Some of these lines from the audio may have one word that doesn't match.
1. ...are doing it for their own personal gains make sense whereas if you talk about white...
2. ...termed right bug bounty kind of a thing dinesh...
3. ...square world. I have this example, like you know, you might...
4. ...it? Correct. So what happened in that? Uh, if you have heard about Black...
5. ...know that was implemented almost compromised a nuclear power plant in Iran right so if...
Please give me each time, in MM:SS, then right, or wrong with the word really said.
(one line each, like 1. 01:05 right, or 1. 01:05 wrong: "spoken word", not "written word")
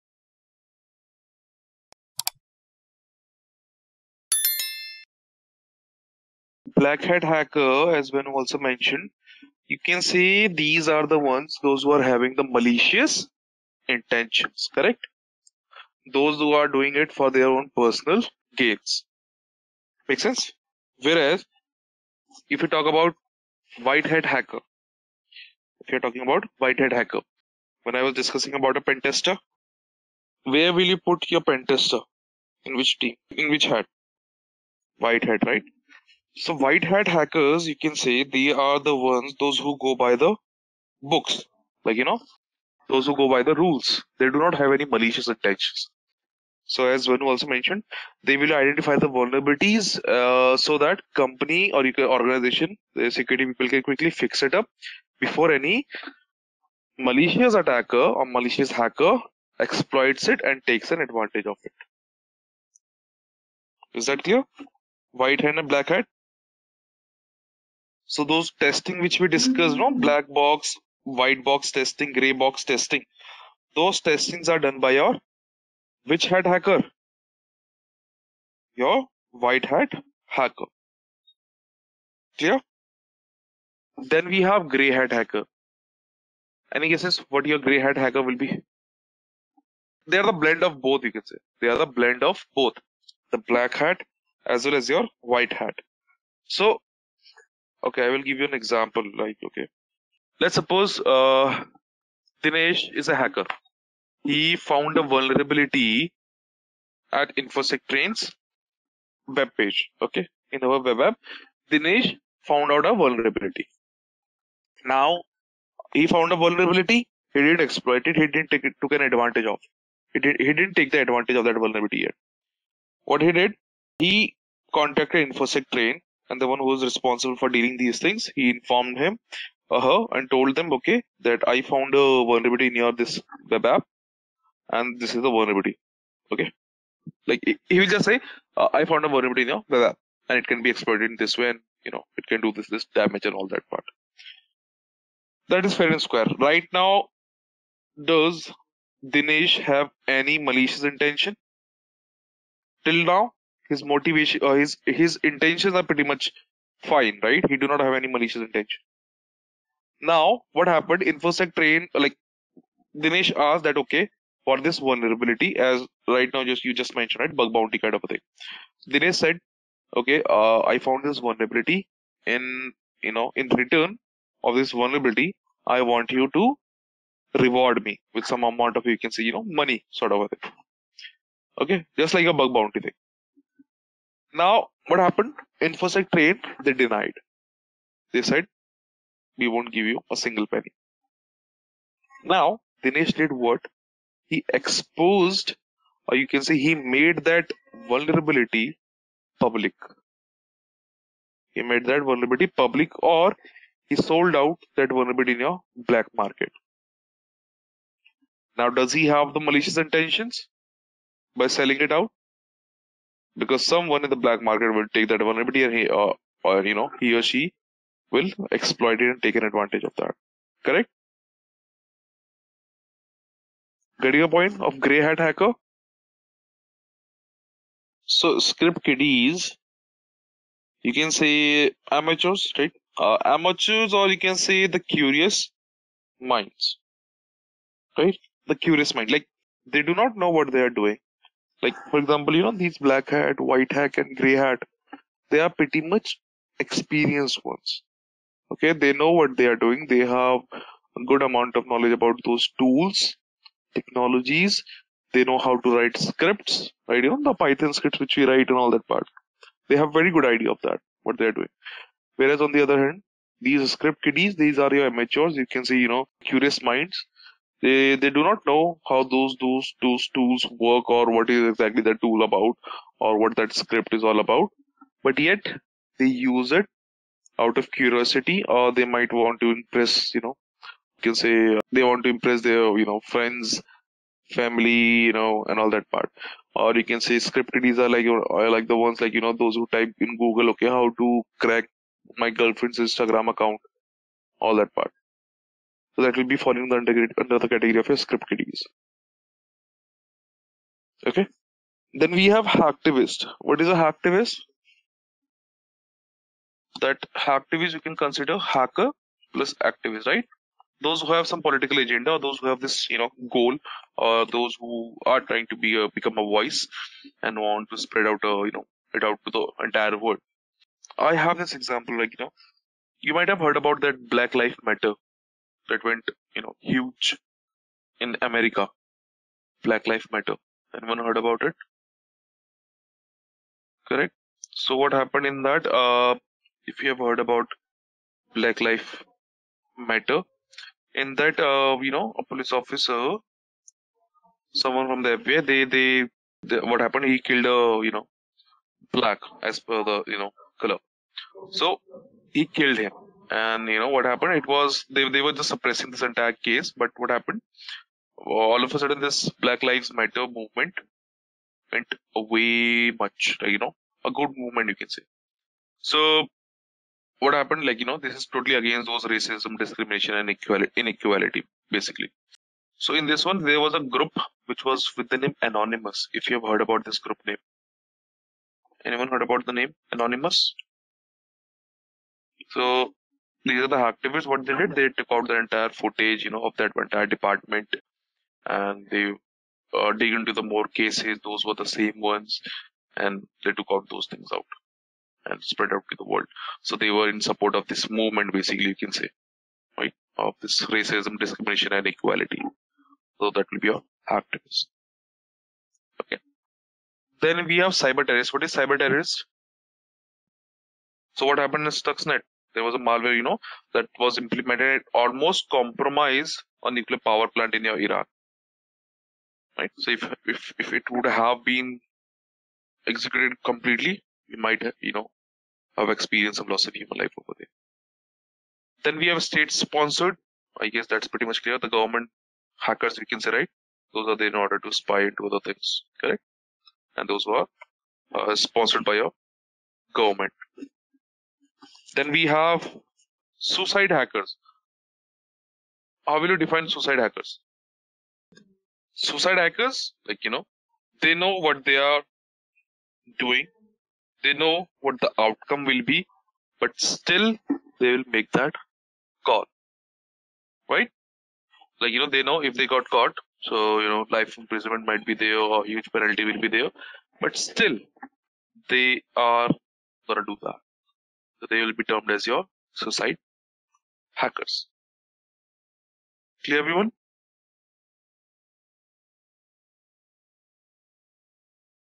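1. 00:16 right
2. 02:46 wrong: "mentioned", not "termed"
3. 05:19 wrong: "entire", not "square"
4. 05:31 right
5. 06:53 right.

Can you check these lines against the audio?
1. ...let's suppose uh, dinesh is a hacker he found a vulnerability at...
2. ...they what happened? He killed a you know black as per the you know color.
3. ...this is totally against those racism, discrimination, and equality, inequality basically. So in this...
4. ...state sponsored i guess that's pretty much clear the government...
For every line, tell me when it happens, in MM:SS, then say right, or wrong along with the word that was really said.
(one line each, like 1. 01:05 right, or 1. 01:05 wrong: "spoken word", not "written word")
1. 01:40 right
2. 05:46 right
3. 06:07 right
4. 07:09 right.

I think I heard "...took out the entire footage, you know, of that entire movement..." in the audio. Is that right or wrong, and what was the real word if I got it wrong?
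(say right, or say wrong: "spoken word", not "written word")
wrong: "department", not "movement".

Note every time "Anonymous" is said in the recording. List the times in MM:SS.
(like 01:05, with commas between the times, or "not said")
06:15, 06:19.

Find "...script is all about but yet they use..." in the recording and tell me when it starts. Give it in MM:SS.
04:33.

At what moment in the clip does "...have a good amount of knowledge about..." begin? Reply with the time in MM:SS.
04:09.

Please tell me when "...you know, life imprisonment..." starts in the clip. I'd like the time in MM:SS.
07:43.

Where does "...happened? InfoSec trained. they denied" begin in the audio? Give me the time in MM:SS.
03:04.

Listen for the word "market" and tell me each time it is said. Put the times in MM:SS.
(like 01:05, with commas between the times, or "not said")
03:26, 03:34.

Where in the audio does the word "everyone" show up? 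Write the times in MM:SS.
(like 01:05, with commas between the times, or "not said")
07:56.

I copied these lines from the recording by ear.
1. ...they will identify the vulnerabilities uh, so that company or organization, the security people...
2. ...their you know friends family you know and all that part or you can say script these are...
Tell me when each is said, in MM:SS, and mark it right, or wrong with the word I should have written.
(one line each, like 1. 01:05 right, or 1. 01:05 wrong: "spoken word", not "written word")
1. 00:48 right
2. 04:42 right.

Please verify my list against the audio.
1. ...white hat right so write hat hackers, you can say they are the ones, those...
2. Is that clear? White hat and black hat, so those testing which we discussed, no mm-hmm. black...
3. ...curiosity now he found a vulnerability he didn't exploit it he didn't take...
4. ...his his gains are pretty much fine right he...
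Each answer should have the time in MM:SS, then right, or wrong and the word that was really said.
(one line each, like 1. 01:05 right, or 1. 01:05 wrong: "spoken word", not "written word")
1. 00:35 wrong: "white", not "write"
2. 01:03 right
3. 01:53 wrong: "vulnerability", not "curiosity"
4. 02:34 wrong: "intentions", not "gains".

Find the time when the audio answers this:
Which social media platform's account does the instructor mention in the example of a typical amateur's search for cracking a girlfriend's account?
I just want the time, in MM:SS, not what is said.
04:52.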